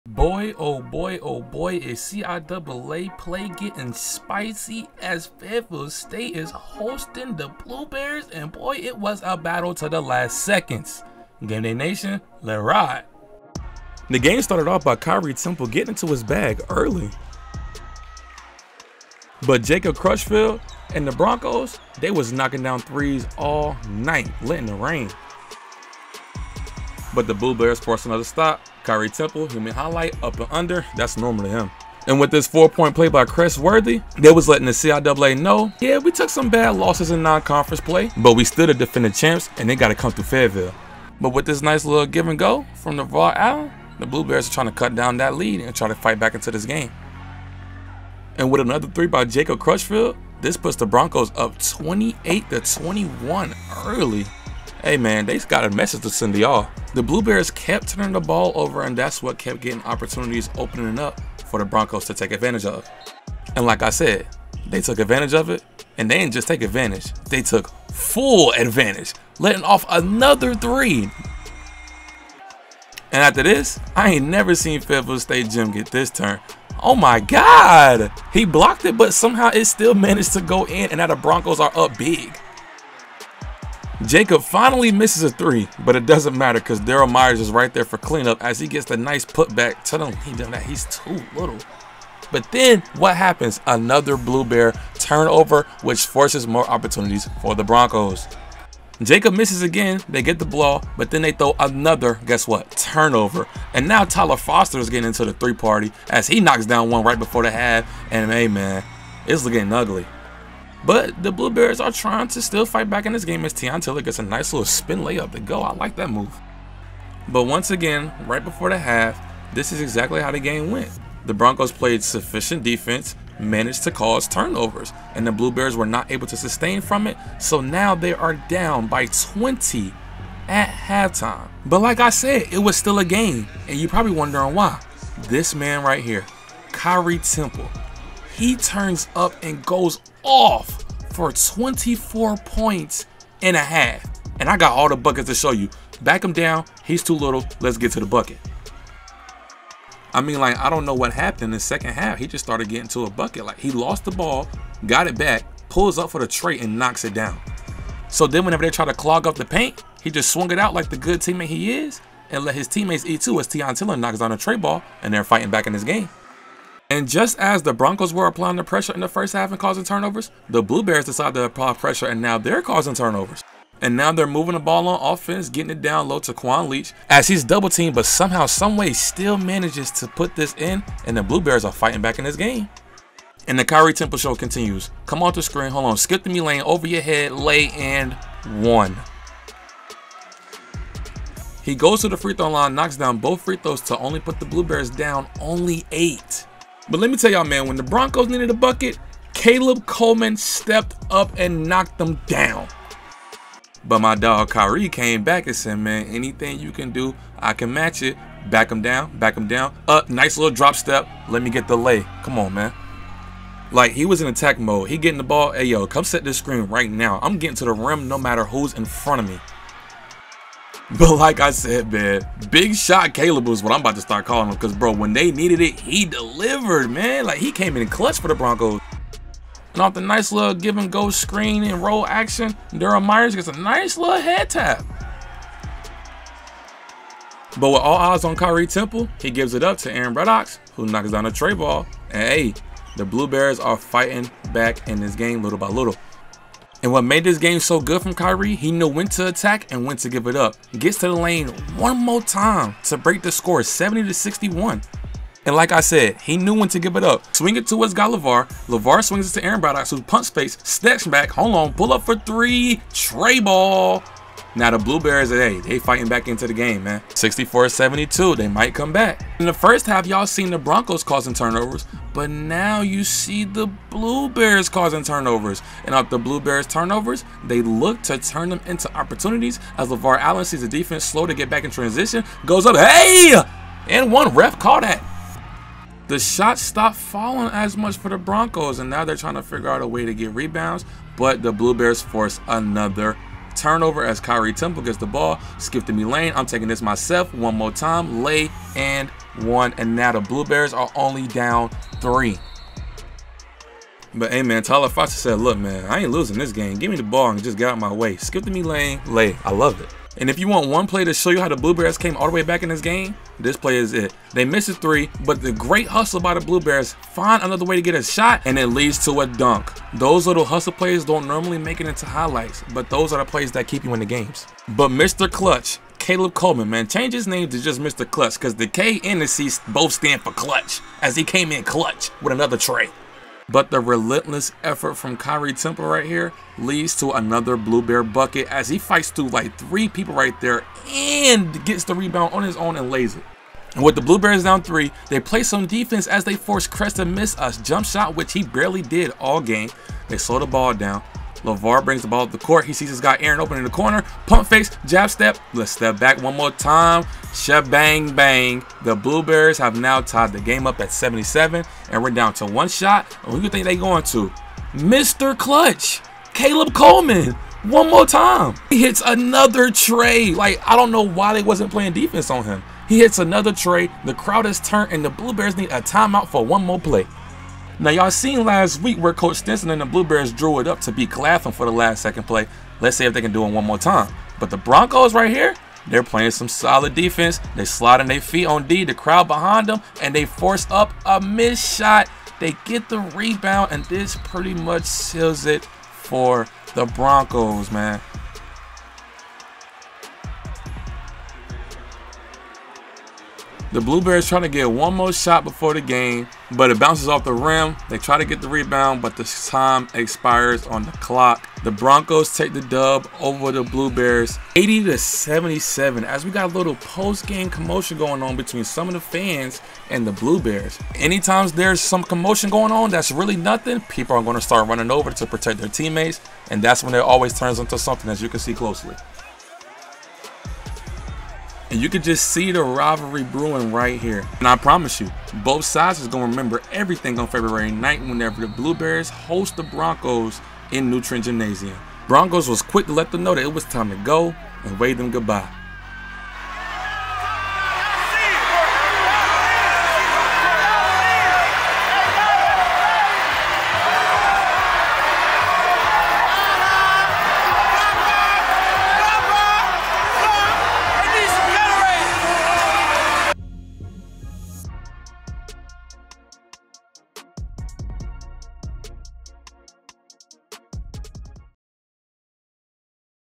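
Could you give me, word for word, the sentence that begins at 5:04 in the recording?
But hey man, Tyler Foster said, look man, I ain't losing this game.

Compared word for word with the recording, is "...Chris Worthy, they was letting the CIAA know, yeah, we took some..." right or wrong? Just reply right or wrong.
right.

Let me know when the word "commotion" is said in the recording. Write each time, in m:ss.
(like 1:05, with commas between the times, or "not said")
6:57, 7:02.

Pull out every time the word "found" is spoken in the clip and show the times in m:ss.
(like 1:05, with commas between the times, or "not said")
not said.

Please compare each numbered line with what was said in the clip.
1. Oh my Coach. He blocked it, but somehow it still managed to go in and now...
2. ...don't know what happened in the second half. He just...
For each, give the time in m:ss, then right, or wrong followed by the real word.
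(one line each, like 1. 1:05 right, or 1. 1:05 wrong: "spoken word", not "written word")
1. 1:16 wrong: "God", not "Coach"
2. 2:30 right.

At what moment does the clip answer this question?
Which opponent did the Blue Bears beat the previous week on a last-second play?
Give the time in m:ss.
6:21.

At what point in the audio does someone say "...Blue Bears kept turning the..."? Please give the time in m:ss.
0:57.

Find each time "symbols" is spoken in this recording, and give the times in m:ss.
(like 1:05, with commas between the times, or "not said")
not said.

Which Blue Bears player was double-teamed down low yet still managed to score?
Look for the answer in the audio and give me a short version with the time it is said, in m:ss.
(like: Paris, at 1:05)
Quan Leach, at 2:56.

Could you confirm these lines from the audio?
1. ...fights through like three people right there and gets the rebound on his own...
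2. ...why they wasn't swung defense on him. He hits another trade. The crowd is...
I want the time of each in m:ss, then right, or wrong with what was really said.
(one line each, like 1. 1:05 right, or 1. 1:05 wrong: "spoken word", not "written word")
1. 5:38 right
2. 6:11 wrong: "playing", not "swung".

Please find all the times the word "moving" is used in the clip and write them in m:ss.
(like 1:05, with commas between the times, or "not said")
2:54.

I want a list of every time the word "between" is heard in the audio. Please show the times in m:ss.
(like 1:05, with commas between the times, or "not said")
6:58.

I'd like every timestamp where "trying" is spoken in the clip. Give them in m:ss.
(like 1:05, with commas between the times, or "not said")
0:44, 1:51, 4:49, 6:44.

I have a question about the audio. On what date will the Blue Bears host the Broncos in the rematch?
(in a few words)
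February 9.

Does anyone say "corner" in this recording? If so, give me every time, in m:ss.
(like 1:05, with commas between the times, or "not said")
5:53.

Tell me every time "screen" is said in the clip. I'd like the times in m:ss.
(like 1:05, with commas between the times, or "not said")
3:05, 3:36, 3:51.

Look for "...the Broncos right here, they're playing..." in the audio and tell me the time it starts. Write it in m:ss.
6:24.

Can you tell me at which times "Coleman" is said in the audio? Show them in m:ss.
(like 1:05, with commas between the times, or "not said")
3:19, 5:26, 6:06.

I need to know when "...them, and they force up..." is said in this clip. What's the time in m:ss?
6:29.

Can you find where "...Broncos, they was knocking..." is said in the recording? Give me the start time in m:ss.
0:21.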